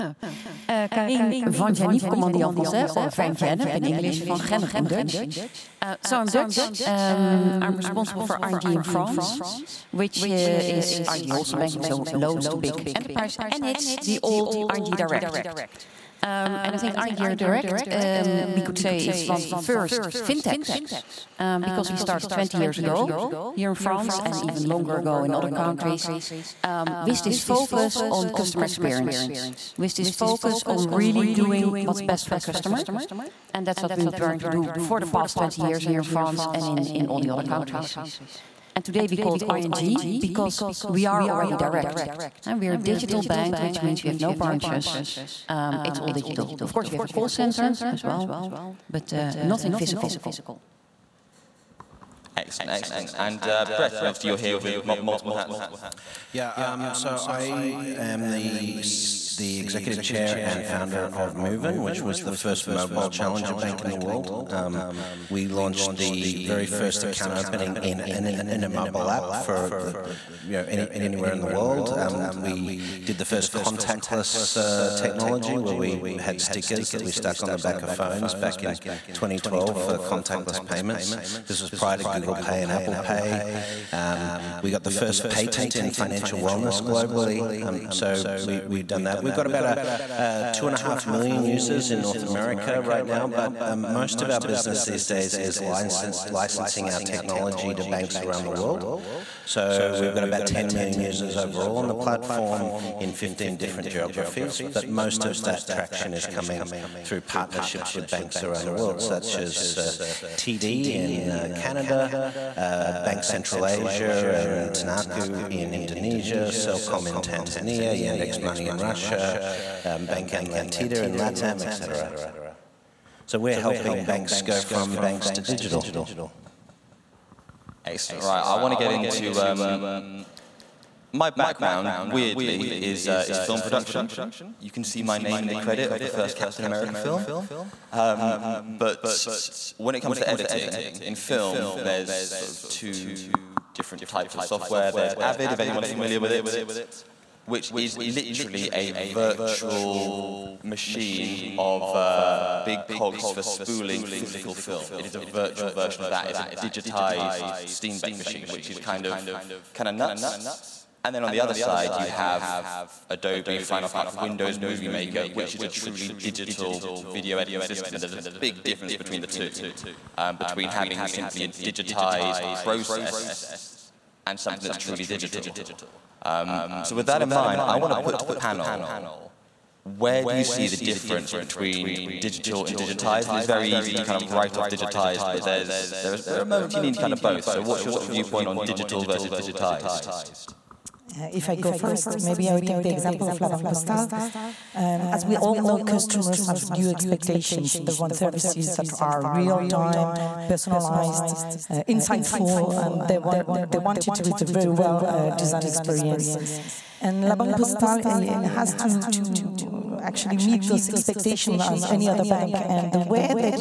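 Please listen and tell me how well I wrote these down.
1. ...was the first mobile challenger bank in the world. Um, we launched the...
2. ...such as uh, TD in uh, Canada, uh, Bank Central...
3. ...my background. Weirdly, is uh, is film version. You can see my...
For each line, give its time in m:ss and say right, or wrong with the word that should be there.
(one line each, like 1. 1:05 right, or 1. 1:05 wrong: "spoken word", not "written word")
1. 1:02 right
2. 1:48 right
3. 2:11 wrong: "production", not "version".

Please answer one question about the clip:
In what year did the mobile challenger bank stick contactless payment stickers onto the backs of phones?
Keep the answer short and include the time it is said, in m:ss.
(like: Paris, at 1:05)
2012, at 1:19.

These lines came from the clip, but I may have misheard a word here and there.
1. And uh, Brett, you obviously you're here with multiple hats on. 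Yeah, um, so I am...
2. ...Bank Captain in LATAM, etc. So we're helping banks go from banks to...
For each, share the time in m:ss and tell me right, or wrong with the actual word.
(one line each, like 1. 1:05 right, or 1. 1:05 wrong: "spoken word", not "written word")
1. 0:53 right
2. 2:00 wrong: "Atlantida", not "Captain".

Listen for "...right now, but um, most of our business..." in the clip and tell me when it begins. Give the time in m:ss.
1:32.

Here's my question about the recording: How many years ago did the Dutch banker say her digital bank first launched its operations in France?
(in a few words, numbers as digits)
20.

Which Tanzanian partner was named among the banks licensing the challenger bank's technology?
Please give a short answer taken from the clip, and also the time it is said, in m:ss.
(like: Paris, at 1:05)
Selcom, at 1:56.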